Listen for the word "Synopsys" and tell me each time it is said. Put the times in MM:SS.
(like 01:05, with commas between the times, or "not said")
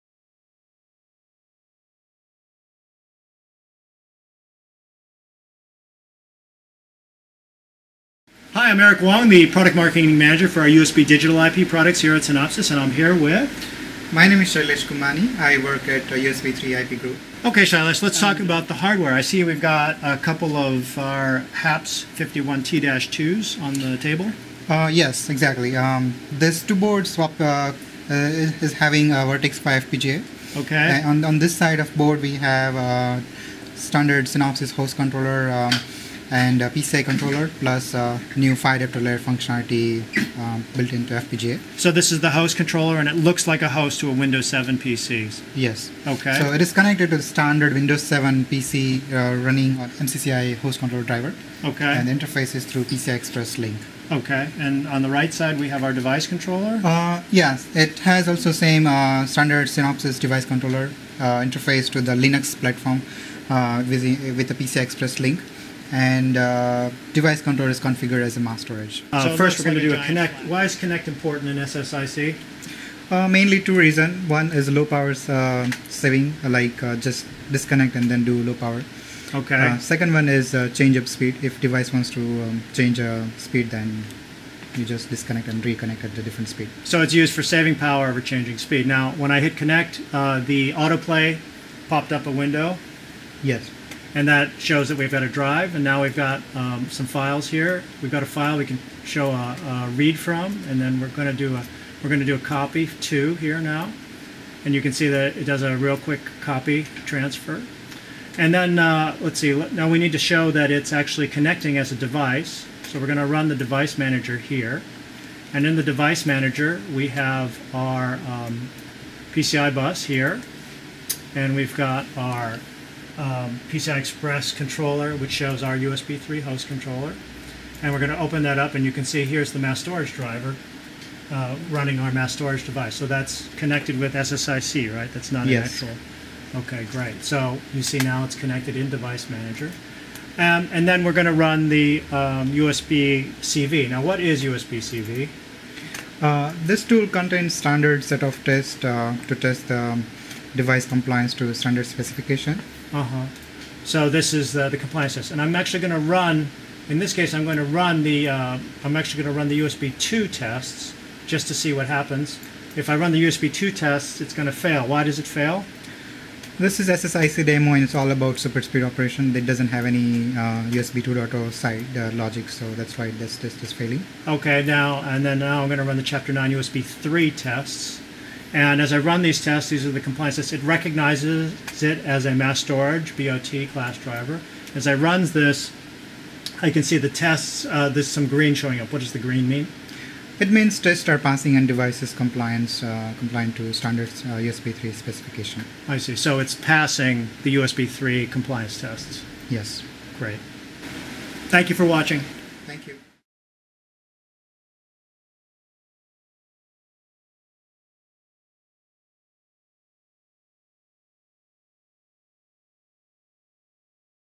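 00:12, 00:34, 00:59.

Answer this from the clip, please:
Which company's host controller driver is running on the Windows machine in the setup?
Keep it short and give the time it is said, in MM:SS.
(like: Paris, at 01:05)
MCCI, at 00:49.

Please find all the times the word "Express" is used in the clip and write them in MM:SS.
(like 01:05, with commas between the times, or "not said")
00:53, 01:04, 02:03.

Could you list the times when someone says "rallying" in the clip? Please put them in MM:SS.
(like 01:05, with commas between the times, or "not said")
not said.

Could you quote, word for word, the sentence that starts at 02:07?
And we're going to open that up, and you can see here's the mass storage driver uh, running our mass storage device.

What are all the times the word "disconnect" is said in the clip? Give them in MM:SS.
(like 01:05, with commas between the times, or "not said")
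01:17, 01:25.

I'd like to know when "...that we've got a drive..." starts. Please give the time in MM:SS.
01:34.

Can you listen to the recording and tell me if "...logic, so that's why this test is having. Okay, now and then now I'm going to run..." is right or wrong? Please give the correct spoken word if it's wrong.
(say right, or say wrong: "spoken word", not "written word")
wrong: "failing", not "having".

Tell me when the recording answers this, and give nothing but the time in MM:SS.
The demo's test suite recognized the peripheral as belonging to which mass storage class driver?
03:02.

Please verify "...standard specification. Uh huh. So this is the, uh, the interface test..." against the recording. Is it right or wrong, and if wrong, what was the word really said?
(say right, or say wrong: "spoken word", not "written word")
wrong: "compliance", not "interface".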